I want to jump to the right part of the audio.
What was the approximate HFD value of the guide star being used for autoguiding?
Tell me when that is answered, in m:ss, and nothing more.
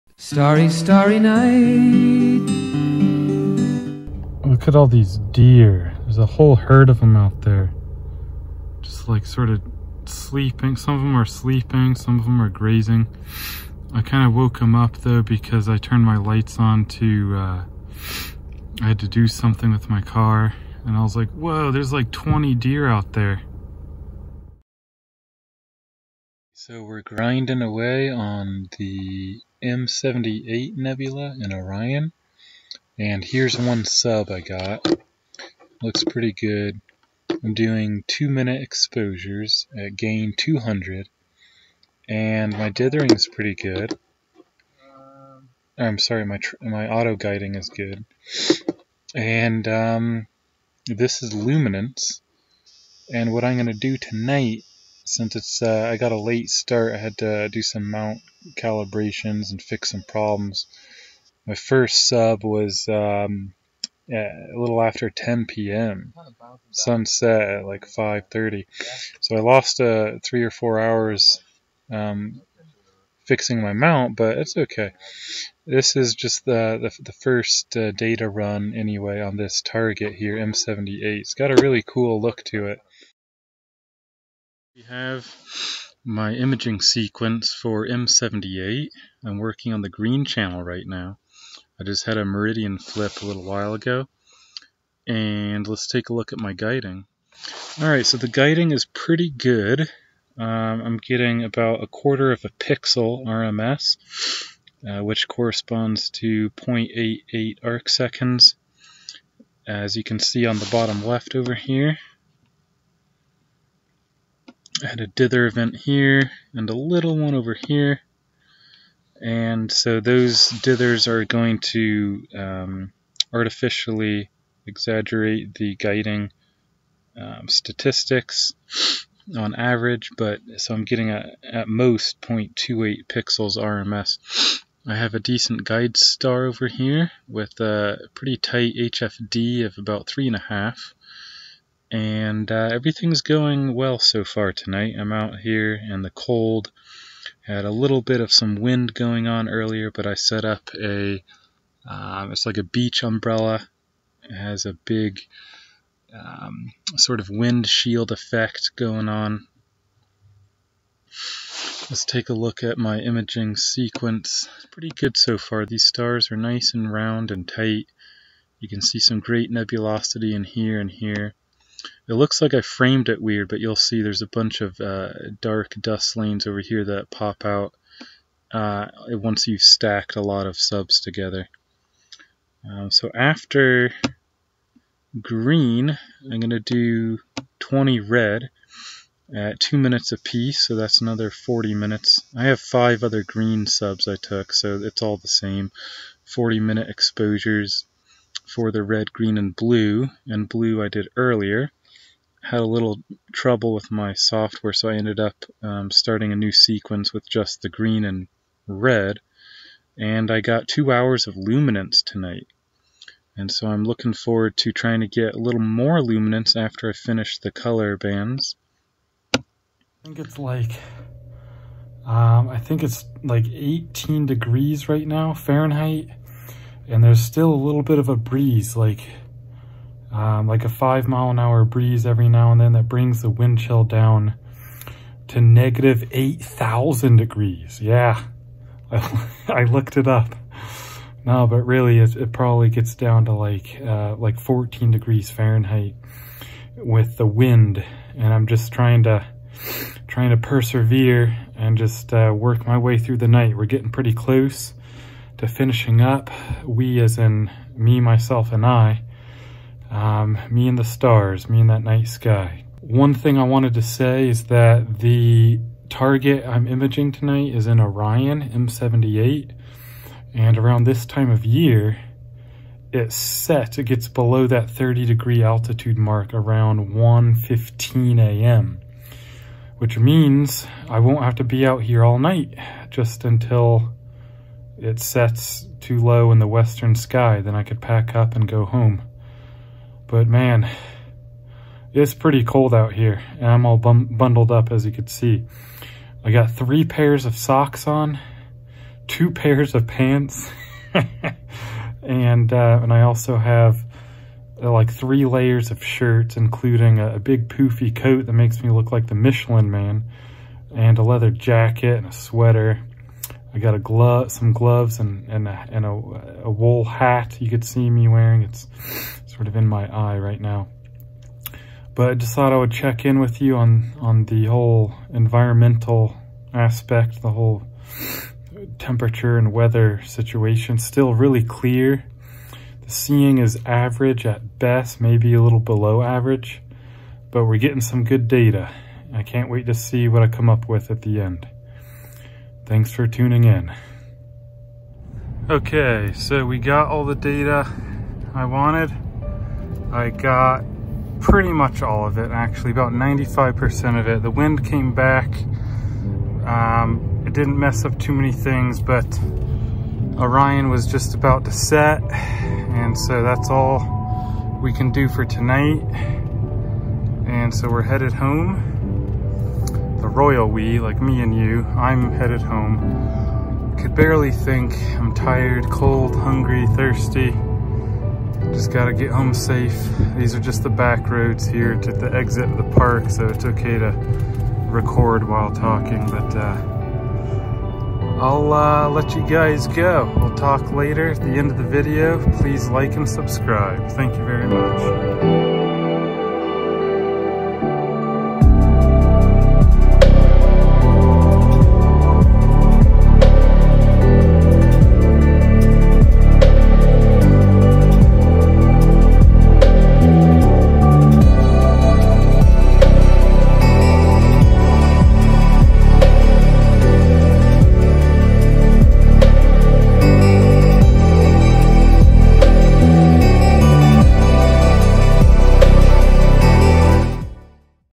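2:19.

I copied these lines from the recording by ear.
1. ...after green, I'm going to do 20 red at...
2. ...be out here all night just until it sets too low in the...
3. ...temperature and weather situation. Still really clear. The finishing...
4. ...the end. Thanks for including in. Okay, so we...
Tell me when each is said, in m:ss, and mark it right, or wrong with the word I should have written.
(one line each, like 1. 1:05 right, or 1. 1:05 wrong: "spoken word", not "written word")
1. 3:03 right
2. 4:41 right
3. 5:28 wrong: "seeing", not "finishing"
4. 5:41 wrong: "tuning", not "including".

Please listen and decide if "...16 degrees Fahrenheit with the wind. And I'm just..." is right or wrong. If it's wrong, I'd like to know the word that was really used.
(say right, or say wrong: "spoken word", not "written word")
wrong: "14", not "16".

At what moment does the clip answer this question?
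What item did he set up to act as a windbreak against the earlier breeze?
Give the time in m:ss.
2:32.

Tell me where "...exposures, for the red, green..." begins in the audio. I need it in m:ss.
3:16.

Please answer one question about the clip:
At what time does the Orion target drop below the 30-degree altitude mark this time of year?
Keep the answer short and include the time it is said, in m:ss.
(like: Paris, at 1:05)
1:15 a.m., at 4:36.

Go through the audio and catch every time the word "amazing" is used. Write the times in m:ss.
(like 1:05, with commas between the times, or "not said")
not said.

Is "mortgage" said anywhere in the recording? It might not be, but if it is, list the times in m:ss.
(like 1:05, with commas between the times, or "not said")
not said.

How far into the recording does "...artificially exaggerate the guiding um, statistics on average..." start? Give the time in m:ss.
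2:03.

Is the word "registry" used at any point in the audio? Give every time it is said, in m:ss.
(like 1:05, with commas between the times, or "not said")
not said.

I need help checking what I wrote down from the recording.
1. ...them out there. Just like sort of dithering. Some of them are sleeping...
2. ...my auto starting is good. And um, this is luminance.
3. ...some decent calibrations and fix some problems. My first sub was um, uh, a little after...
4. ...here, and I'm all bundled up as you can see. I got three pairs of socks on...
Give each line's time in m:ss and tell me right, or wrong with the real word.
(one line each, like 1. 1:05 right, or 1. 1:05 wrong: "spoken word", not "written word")
1. 0:06 wrong: "sleeping", not "dithering"
2. 0:46 wrong: "guiding", not "starting"
3. 0:57 wrong: "mount", not "decent"
4. 4:52 right.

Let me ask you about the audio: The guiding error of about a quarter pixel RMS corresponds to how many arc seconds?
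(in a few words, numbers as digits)
0.88.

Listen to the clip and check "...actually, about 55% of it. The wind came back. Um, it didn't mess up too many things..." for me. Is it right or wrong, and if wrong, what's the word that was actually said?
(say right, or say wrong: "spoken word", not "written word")
wrong: "95", not "55".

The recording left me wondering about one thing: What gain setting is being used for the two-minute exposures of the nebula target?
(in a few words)
200.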